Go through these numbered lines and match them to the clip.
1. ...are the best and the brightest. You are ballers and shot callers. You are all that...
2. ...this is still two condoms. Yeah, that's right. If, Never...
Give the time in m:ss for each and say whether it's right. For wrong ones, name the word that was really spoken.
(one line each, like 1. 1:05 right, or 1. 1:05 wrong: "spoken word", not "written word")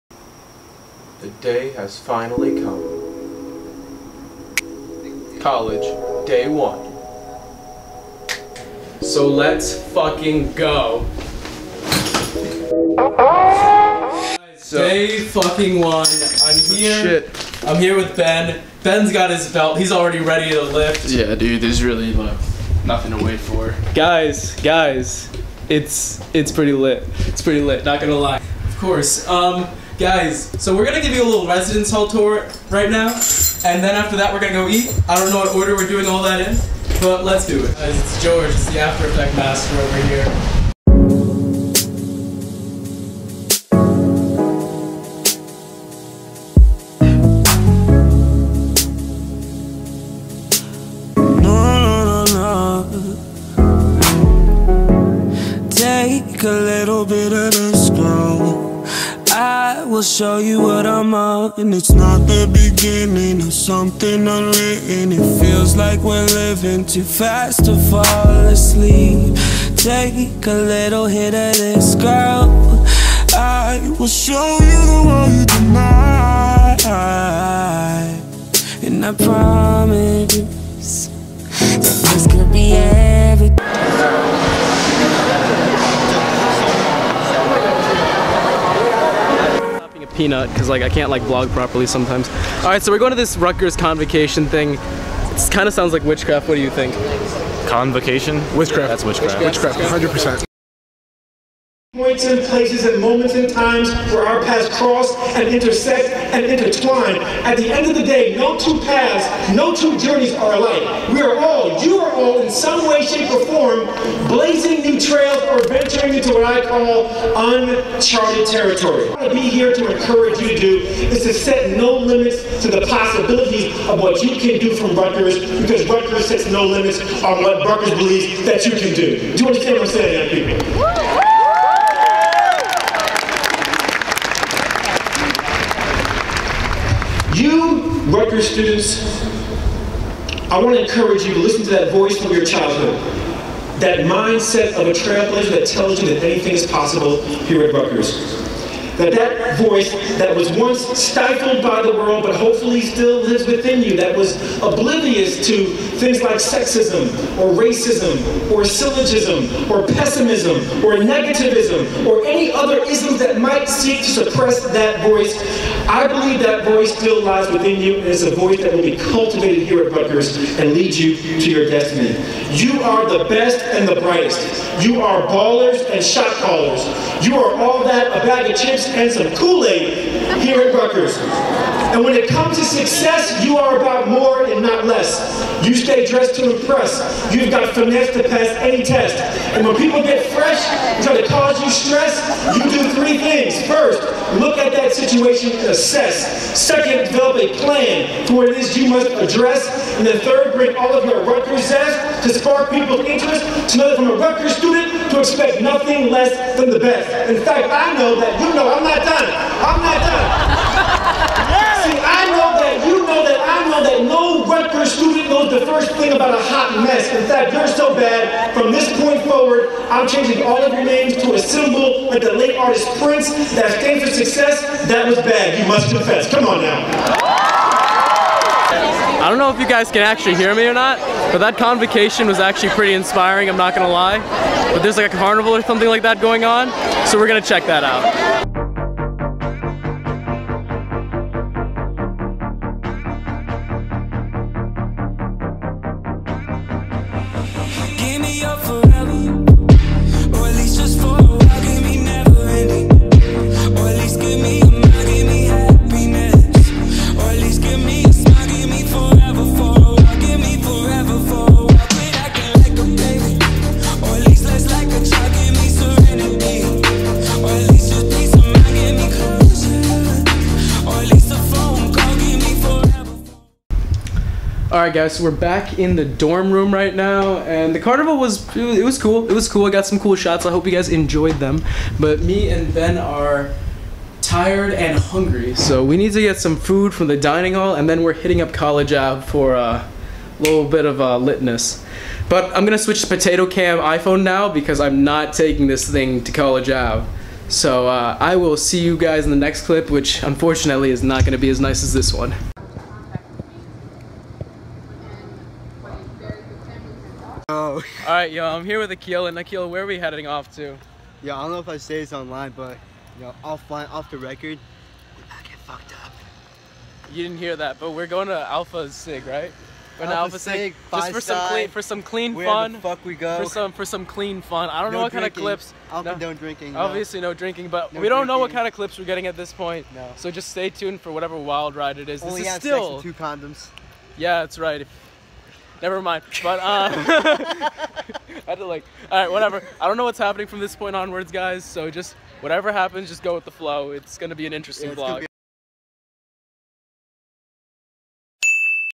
1. 2:52 right
2. 5:32 right.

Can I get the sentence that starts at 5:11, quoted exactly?
Yeah, I don't know if I say this online, but, you know, offline, off the record, we get fucked up.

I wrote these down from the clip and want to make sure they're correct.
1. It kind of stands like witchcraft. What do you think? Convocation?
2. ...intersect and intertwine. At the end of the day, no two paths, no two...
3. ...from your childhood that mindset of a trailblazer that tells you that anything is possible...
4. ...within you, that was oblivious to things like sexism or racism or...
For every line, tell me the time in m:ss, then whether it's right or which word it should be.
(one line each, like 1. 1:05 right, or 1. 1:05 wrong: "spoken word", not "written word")
1. 1:34 wrong: "sounds", not "stands"
2. 1:45 right
3. 2:22 right
4. 2:33 right.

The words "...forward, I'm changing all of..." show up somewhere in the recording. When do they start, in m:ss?
3:39.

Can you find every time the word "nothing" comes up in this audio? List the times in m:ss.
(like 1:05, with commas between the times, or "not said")
0:22, 3:25.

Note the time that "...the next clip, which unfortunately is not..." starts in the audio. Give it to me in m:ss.
4:59.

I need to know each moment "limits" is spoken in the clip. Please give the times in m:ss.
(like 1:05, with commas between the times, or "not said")
2:01, 2:06.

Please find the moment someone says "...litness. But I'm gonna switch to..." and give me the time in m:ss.
4:51.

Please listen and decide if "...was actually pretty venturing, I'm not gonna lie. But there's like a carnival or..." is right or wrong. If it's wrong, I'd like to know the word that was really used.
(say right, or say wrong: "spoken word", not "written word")
wrong: "inspiring", not "venturing".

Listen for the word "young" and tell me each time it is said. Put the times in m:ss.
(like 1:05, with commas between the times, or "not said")
2:10.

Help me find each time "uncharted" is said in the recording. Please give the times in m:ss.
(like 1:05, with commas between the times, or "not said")
1:57.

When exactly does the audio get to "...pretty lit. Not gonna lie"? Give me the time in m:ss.
0:27.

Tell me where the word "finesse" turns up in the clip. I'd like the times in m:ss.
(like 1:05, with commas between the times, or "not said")
3:07.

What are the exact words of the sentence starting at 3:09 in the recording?
And when people get fresh try to cause you stress, you do three things.